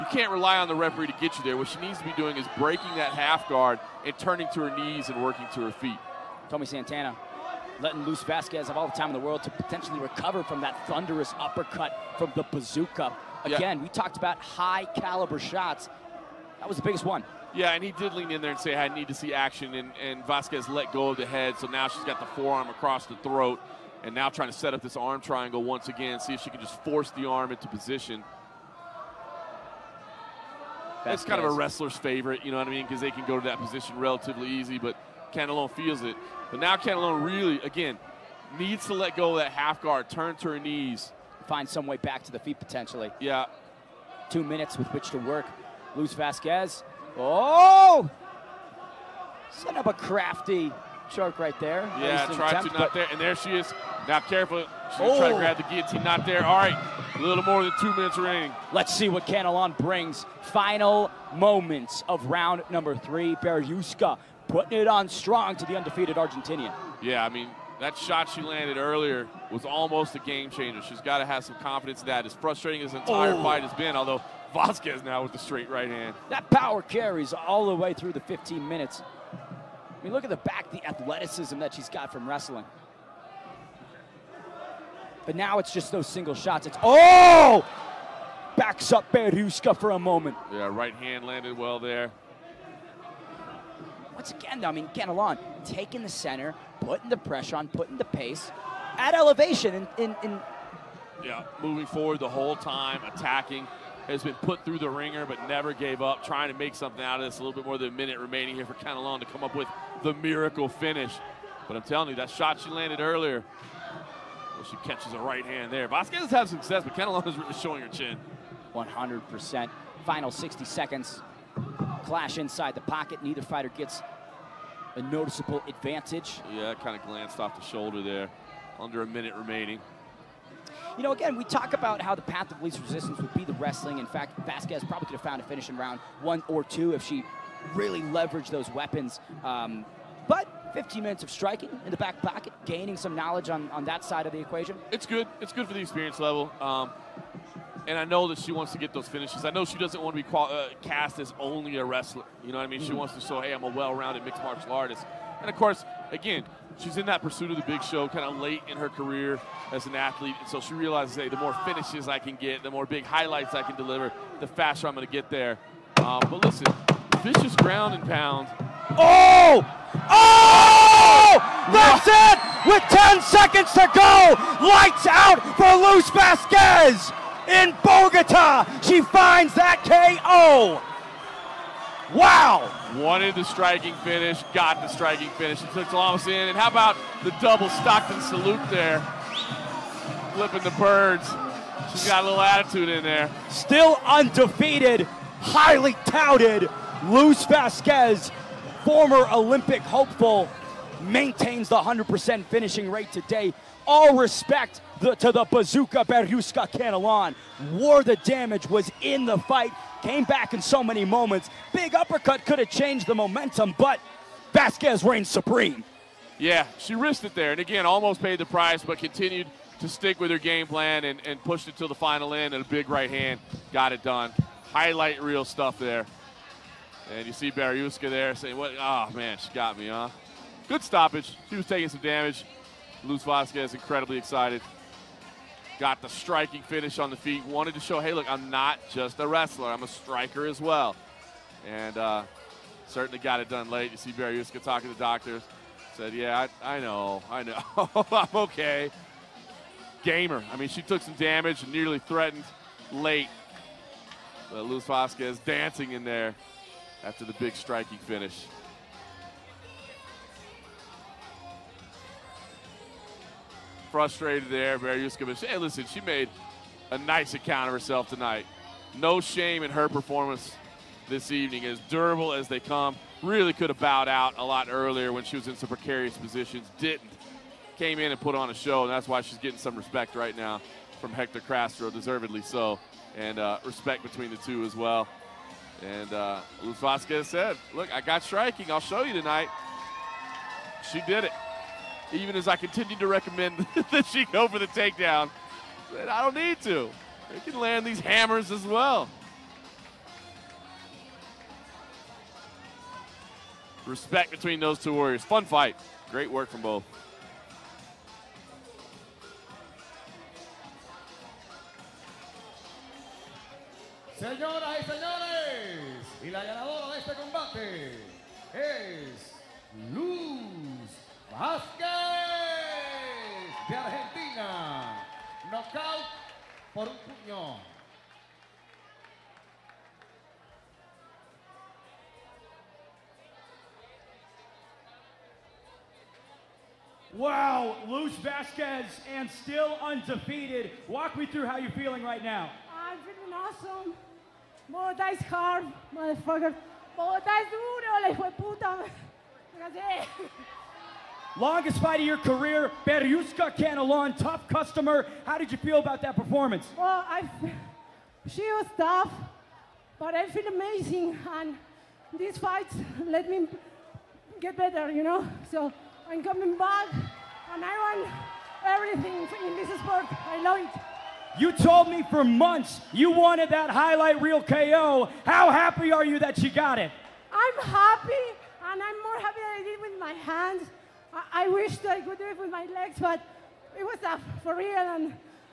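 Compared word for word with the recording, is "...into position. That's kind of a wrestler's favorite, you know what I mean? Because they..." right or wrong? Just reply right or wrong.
right.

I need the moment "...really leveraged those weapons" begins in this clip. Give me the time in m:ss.
2:17.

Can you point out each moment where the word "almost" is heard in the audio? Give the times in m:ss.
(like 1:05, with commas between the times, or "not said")
1:09, 3:37.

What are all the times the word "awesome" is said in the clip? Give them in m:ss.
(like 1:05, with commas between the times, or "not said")
5:43.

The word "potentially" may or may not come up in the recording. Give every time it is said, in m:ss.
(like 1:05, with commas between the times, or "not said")
0:09, 0:42.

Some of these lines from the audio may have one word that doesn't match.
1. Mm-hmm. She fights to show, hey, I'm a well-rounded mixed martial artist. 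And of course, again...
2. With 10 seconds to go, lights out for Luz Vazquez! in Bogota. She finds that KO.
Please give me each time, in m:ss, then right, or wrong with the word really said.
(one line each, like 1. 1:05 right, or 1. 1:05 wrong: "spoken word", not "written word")
1. 2:32 wrong: "wants", not "fights"
2. 2:52 right.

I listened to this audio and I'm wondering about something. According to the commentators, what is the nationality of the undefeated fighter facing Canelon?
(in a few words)
Argentinian.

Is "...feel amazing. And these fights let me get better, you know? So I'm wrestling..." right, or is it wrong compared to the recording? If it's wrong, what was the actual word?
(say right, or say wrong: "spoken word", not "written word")
wrong: "coming", not "wrestling".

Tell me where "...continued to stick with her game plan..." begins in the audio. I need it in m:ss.
3:38.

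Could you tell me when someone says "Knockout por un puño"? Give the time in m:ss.
5:25.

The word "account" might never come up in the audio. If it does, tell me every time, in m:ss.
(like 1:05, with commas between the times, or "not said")
4:27.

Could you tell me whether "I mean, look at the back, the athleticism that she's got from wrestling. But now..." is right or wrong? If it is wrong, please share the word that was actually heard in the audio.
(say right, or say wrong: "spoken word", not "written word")
right.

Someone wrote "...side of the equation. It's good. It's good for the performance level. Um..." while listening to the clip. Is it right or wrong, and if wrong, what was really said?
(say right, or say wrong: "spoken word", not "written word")
wrong: "experience", not "performance".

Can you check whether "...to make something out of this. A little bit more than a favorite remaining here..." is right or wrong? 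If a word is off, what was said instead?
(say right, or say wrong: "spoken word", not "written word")
wrong: "minute", not "favorite".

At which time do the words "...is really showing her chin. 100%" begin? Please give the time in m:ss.
1:57.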